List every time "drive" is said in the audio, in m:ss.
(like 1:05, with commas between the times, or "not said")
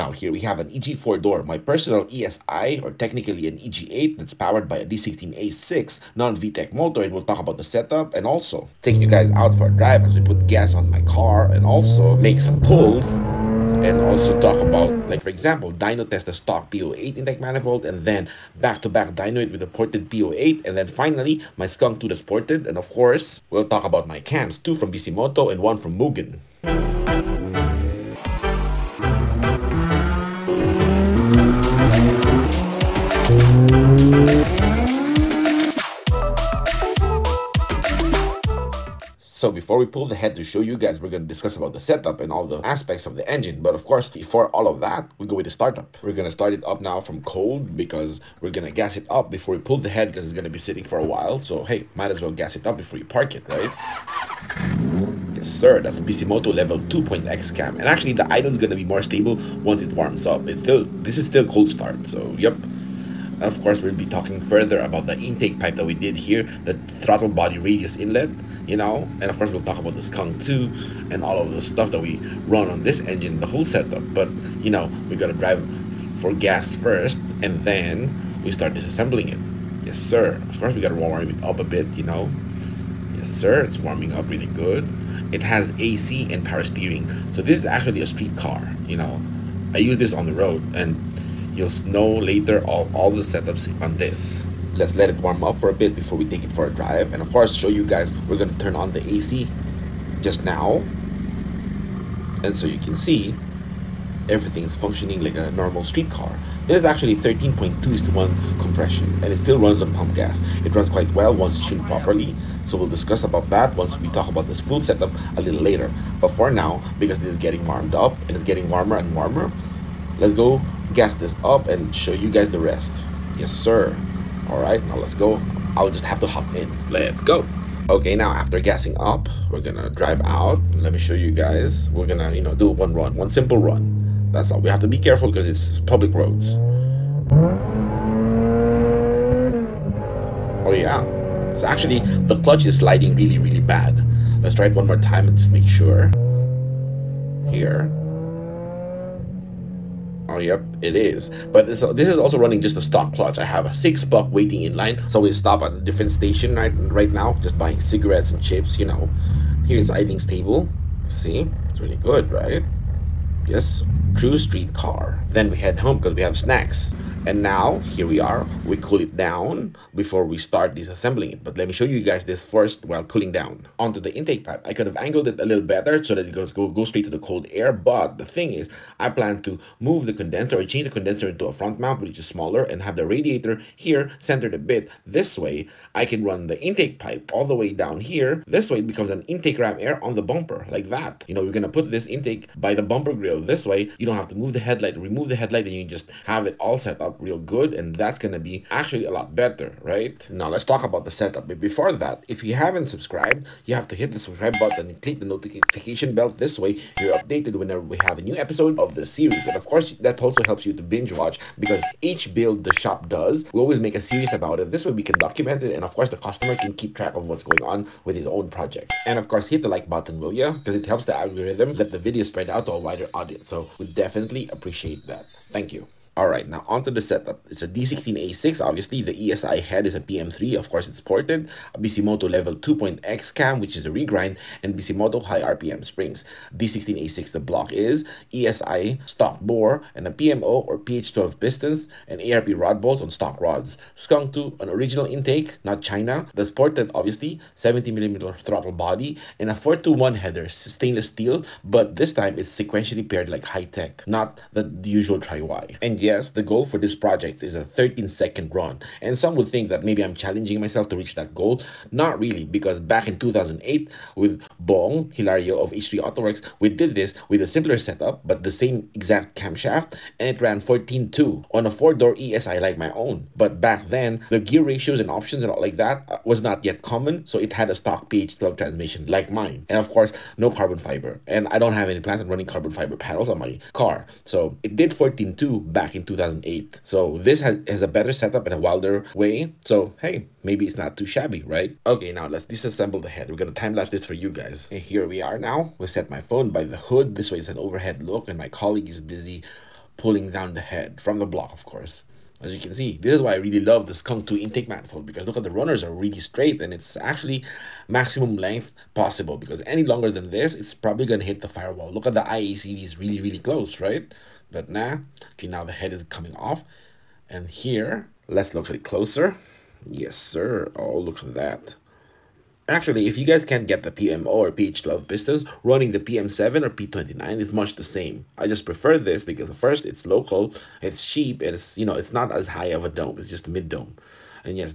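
0:09, 1:15, 1:36, 2:09.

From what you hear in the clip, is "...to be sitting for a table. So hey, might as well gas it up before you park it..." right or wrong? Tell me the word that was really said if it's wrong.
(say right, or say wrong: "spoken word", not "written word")
wrong: "while", not "table".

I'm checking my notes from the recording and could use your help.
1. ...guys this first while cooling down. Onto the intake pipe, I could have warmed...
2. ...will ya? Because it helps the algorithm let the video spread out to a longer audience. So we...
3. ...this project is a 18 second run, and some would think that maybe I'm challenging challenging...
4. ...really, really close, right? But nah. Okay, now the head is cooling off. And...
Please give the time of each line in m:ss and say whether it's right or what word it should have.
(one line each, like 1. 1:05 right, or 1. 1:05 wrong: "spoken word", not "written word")
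1. 2:52 wrong: "angled", not "warmed"
2. 3:40 wrong: "wider", not "longer"
3. 4:16 wrong: "13", not "18"
4. 5:12 wrong: "coming", not "cooling".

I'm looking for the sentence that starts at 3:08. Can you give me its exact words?
This way it becomes an intake ram air on the bumper like that.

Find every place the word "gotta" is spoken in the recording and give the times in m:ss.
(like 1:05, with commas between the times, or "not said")
1:15, 1:20.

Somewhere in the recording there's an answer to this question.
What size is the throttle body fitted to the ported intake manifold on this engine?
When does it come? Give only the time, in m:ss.
4:07.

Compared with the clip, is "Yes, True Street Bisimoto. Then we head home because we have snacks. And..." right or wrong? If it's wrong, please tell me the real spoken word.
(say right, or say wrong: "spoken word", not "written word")
wrong: "Car", not "Bisimoto".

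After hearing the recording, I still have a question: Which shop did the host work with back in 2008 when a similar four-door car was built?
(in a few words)
H3 Autoworks.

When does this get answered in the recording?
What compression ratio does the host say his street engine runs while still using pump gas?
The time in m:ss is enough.
1:47.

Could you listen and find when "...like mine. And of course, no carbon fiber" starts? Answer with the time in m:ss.
4:39.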